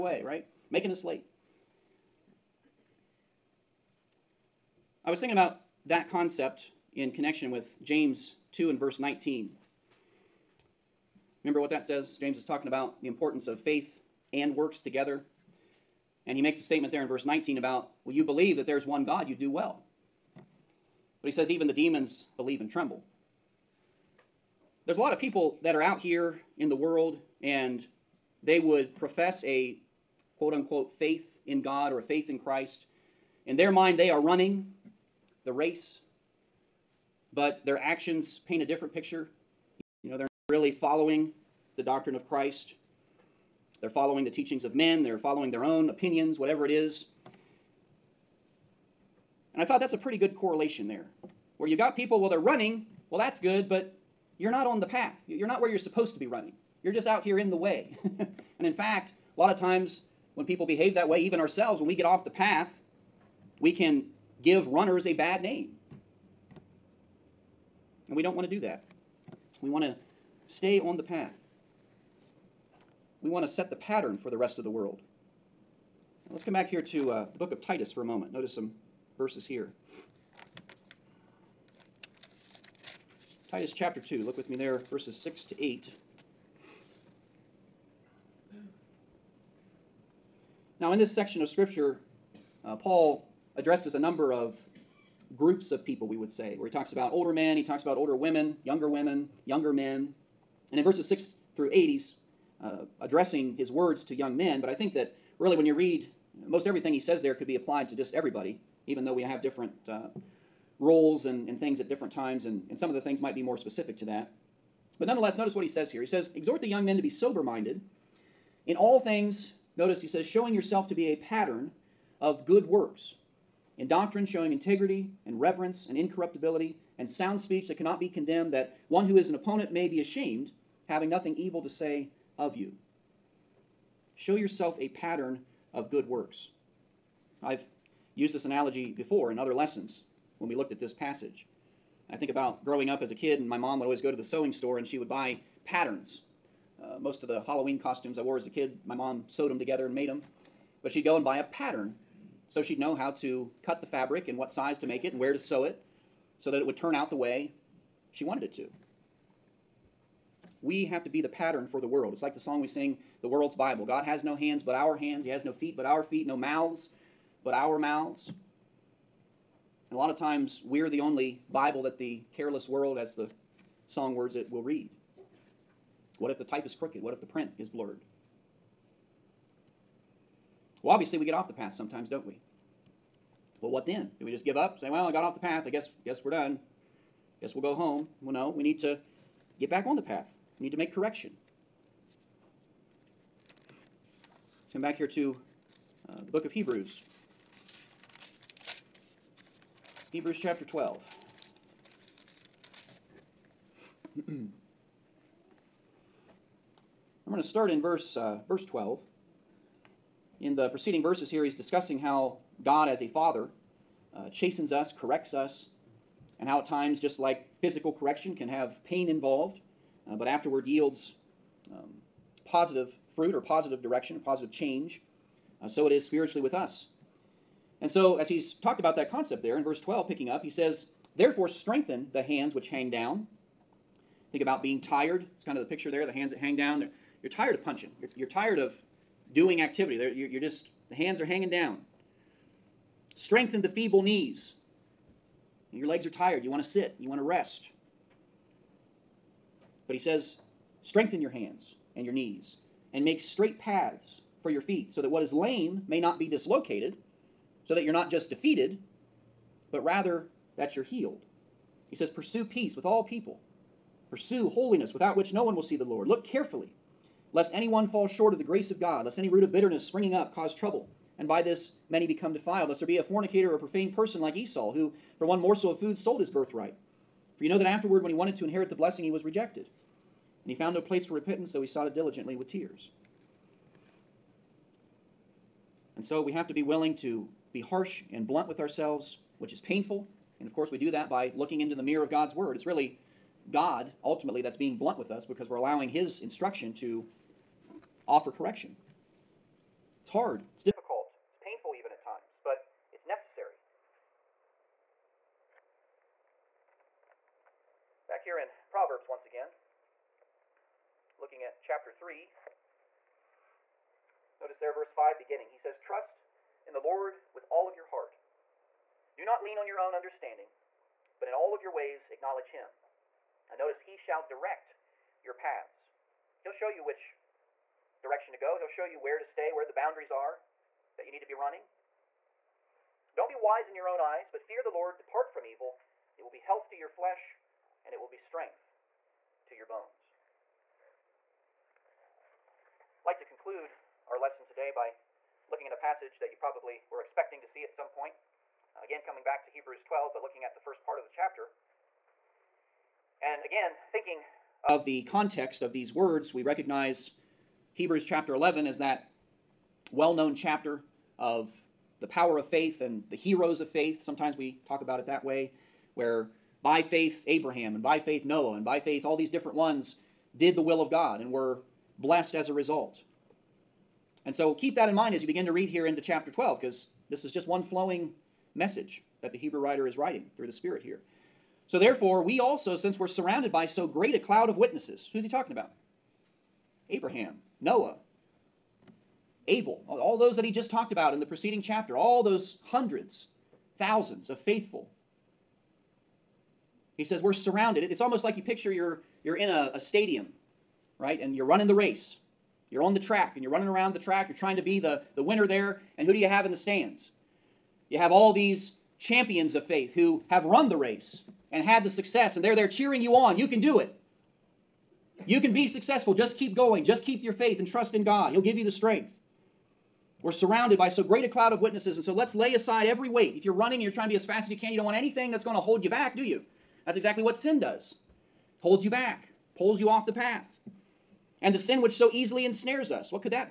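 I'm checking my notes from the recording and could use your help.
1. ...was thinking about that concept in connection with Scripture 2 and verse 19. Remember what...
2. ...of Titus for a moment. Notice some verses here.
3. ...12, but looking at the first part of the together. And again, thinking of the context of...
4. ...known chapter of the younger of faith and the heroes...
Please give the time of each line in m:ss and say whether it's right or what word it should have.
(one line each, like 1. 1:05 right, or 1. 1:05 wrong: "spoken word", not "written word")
1. 0:05 wrong: "James", not "Scripture"
2. 1:17 right
3. 5:49 wrong: "chapter", not "together"
4. 6:00 wrong: "power", not "younger".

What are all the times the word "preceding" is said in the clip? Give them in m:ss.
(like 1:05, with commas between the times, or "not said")
3:30, 6:31.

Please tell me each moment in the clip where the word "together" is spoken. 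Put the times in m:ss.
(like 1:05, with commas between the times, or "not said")
0:14, 2:29.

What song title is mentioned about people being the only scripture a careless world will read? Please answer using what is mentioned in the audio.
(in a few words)
The World's Bible.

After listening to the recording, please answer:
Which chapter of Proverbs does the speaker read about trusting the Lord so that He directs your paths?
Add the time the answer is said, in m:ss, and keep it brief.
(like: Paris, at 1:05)
Chapter 3, at 5:11.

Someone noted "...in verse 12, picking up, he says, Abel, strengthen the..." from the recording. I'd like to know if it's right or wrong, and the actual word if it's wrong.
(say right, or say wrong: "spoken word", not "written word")
wrong: "Therefore", not "Abel".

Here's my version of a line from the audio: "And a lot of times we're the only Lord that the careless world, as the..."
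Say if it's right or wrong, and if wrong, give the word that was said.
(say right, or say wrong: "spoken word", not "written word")
wrong: "Bible", not "Lord".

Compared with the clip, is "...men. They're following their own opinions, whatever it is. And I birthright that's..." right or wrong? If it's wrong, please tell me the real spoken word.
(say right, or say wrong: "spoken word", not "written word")
wrong: "thought", not "birthright".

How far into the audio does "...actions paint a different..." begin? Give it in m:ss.
0:37.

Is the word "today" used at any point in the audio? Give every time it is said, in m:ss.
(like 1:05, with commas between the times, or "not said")
5:44.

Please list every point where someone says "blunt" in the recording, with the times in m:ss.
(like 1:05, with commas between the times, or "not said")
4:48, 4:54.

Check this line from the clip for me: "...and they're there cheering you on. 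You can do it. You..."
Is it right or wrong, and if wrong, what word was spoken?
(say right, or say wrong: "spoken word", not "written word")
right.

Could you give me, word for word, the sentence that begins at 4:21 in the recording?
He says, Pursue peace with all people.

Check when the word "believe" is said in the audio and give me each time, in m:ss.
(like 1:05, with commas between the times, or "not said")
0:18, 0:22.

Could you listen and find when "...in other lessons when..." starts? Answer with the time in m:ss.
2:19.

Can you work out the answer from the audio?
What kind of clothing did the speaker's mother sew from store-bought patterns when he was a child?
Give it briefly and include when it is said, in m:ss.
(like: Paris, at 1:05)
Halloween costumes, at 2:27.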